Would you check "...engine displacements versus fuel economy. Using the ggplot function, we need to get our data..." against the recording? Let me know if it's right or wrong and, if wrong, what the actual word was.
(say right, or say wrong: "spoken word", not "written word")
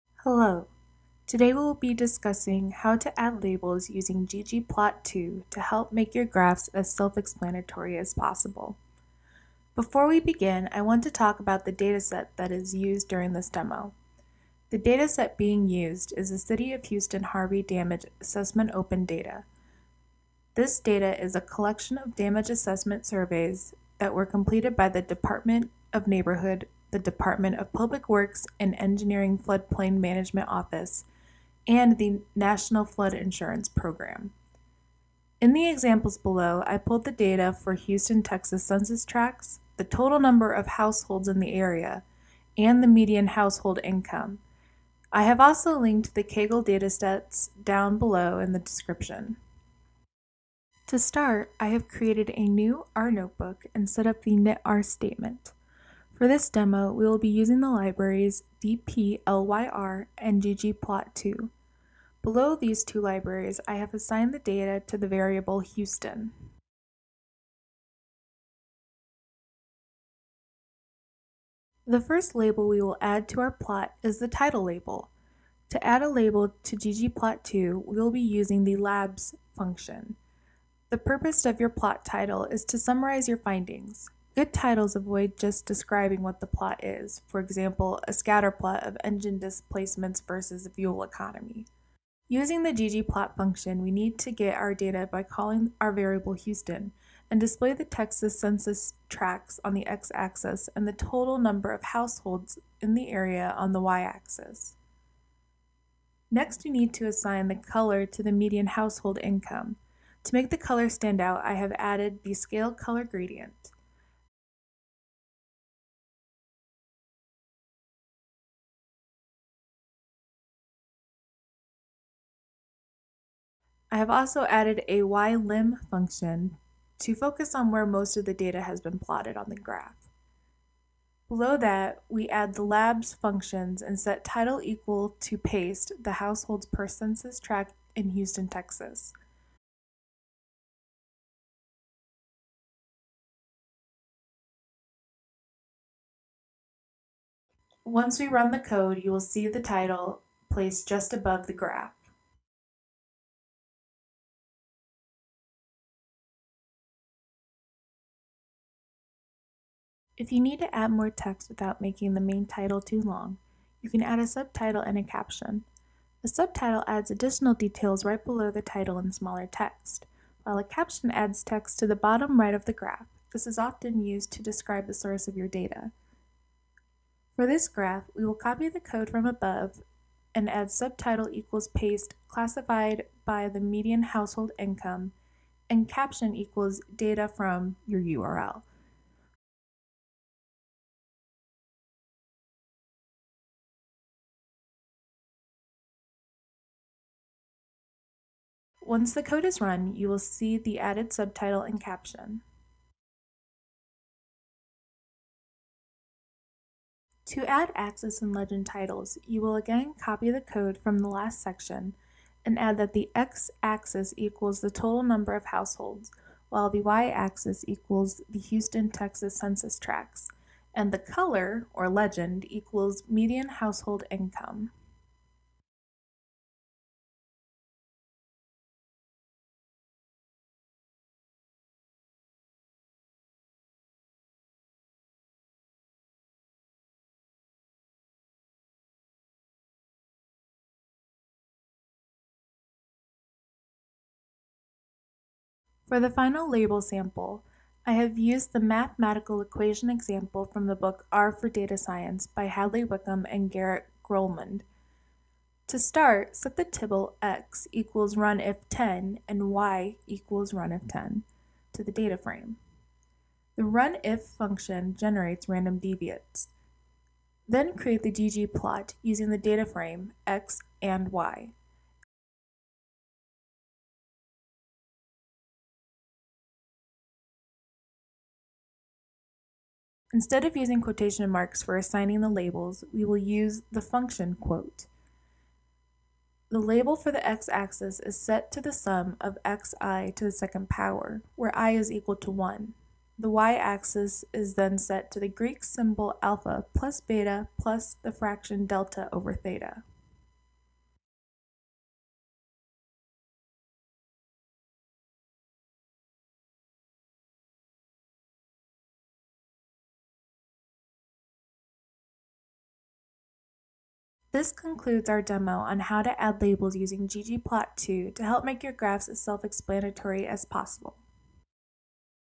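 right.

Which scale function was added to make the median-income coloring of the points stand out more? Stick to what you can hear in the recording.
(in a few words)
scale color gradient.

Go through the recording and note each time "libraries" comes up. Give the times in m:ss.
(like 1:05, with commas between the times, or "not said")
0:57, 1:03.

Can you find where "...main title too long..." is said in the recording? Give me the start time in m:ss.
2:42.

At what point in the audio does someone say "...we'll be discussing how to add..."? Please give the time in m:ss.
0:01.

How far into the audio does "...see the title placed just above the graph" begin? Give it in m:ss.
2:29.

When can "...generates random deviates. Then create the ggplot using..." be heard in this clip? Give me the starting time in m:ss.
4:24.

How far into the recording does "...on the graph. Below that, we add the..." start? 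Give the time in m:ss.
2:09.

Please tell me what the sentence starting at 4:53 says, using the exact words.
The y-axis is then set to the Greek symbol alpha plus beta plus the fraction delta over theta.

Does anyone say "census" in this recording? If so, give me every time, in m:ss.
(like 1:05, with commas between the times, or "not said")
0:38, 1:38, 2:16, 3:39.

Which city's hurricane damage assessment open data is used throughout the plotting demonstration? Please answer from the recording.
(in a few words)
City of Houston.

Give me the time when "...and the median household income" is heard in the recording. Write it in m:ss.
0:42.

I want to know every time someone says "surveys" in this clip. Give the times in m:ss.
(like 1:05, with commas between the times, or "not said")
0:23.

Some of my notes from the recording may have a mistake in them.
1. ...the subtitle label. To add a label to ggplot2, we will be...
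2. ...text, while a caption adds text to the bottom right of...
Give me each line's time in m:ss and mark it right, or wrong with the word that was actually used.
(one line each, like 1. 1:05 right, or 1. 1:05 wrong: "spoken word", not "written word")
1. 1:14 wrong: "title", not "subtitle"
2. 2:49 right.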